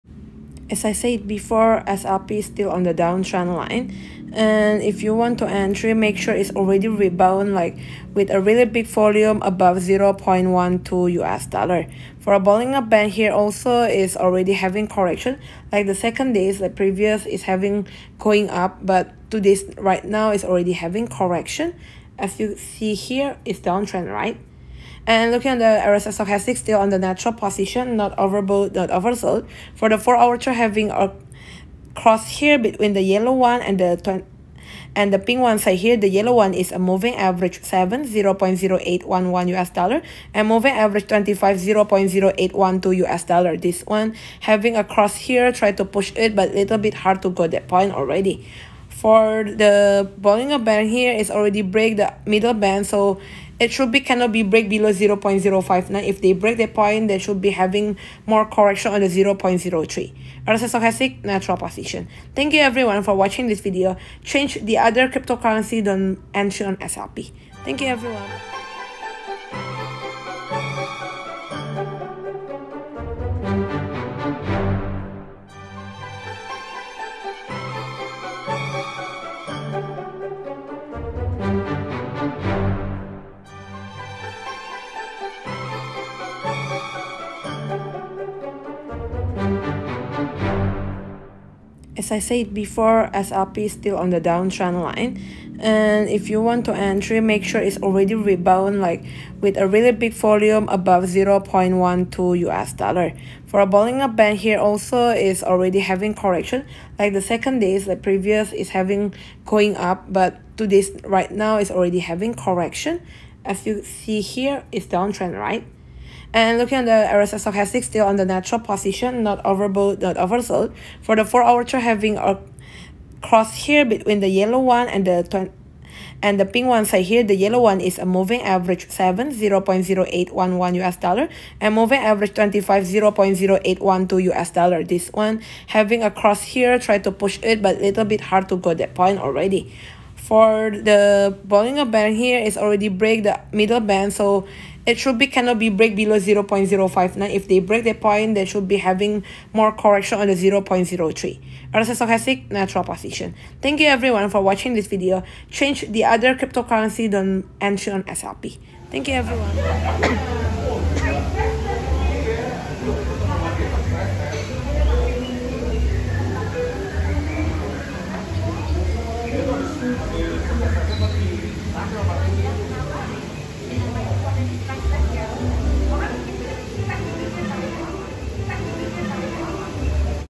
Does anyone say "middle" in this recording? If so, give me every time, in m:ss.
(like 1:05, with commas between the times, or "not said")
0:52, 2:23.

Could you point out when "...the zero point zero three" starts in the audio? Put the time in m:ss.
0:59.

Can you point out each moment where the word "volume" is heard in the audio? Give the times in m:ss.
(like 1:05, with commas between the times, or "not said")
0:08, 1:40.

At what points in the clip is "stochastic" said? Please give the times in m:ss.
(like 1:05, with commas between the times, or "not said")
0:26, 1:00, 1:57, 2:31.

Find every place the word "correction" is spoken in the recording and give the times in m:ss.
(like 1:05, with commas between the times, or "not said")
0:14, 0:21, 0:58, 1:46, 1:52, 2:29.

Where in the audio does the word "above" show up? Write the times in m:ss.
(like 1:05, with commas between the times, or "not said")
0:09, 1:40.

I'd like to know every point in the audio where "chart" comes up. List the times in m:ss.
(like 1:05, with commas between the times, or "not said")
0:30, 2:01.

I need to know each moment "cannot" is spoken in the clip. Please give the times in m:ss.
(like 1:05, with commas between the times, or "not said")
0:54, 2:25.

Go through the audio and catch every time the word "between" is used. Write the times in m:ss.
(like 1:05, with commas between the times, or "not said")
0:32, 2:03.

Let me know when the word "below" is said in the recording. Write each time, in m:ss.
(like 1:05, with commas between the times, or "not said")
0:54, 2:25.